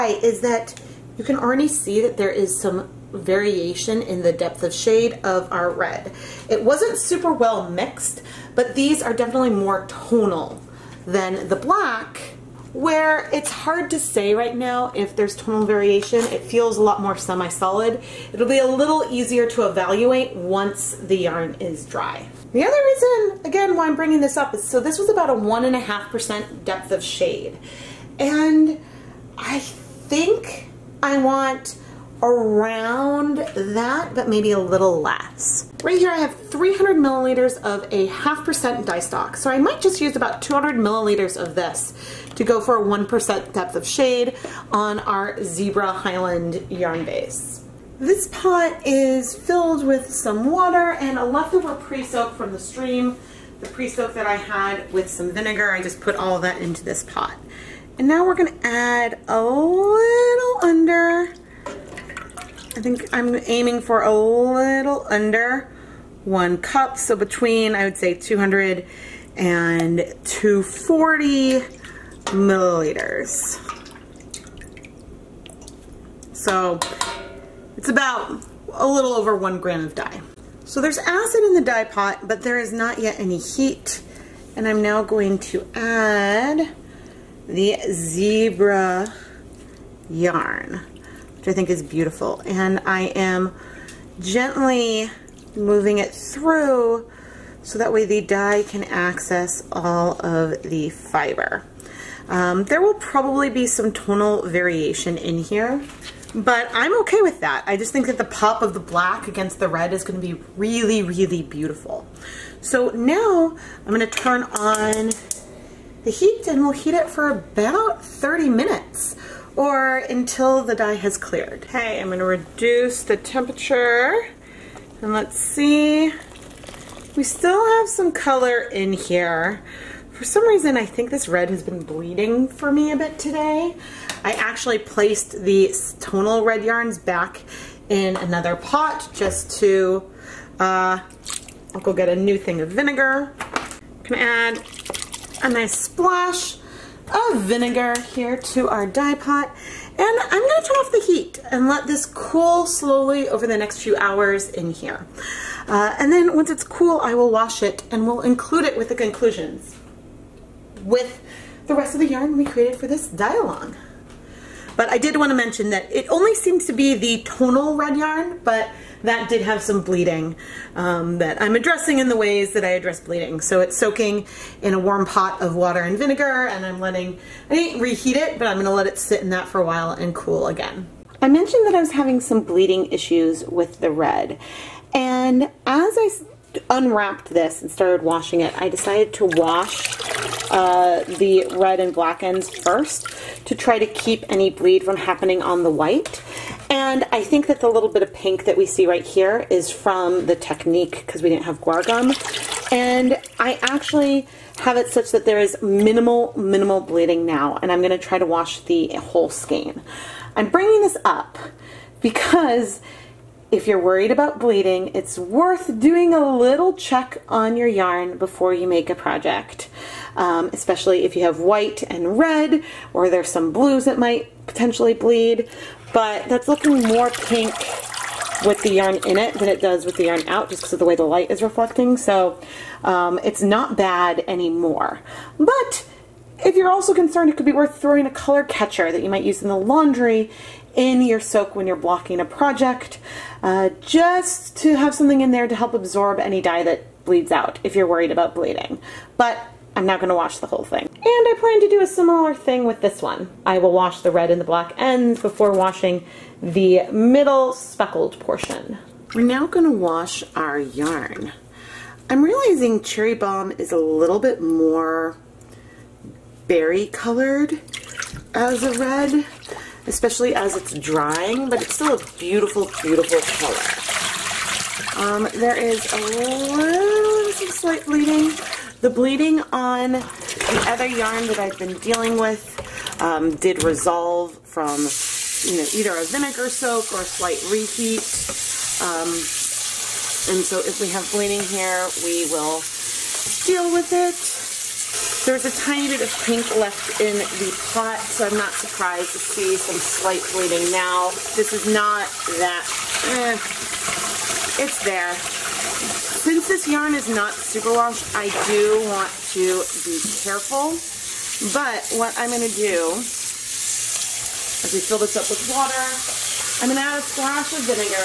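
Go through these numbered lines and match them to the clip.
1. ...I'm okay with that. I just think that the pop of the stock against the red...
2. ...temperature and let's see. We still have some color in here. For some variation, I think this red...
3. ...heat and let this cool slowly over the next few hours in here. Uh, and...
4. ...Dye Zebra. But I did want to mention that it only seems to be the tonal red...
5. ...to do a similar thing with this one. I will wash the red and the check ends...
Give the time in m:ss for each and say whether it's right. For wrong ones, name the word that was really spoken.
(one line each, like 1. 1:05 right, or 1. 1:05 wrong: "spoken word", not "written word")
1. 1:46 wrong: "black", not "stock"
2. 2:03 wrong: "reason", not "variation"
3. 2:31 right
4. 2:43 wrong: "Along", not "Zebra"
5. 4:11 wrong: "black", not "check".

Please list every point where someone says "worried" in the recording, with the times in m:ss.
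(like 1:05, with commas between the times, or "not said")
3:33, 4:07.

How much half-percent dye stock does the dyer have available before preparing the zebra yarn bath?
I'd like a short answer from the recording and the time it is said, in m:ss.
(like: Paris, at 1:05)
300 milliliters, at 0:36.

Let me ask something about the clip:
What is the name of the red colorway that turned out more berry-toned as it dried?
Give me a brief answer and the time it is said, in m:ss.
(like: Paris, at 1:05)
Cherry Bomb, at 4:22.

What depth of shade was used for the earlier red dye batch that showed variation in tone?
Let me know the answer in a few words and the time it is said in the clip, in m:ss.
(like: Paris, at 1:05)
1.5%, at 0:25.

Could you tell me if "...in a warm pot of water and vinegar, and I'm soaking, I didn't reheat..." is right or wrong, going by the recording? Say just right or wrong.
wrong.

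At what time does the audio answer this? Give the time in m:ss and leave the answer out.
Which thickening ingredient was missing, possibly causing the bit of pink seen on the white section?
3:21.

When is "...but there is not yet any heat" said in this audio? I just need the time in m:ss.
1:22.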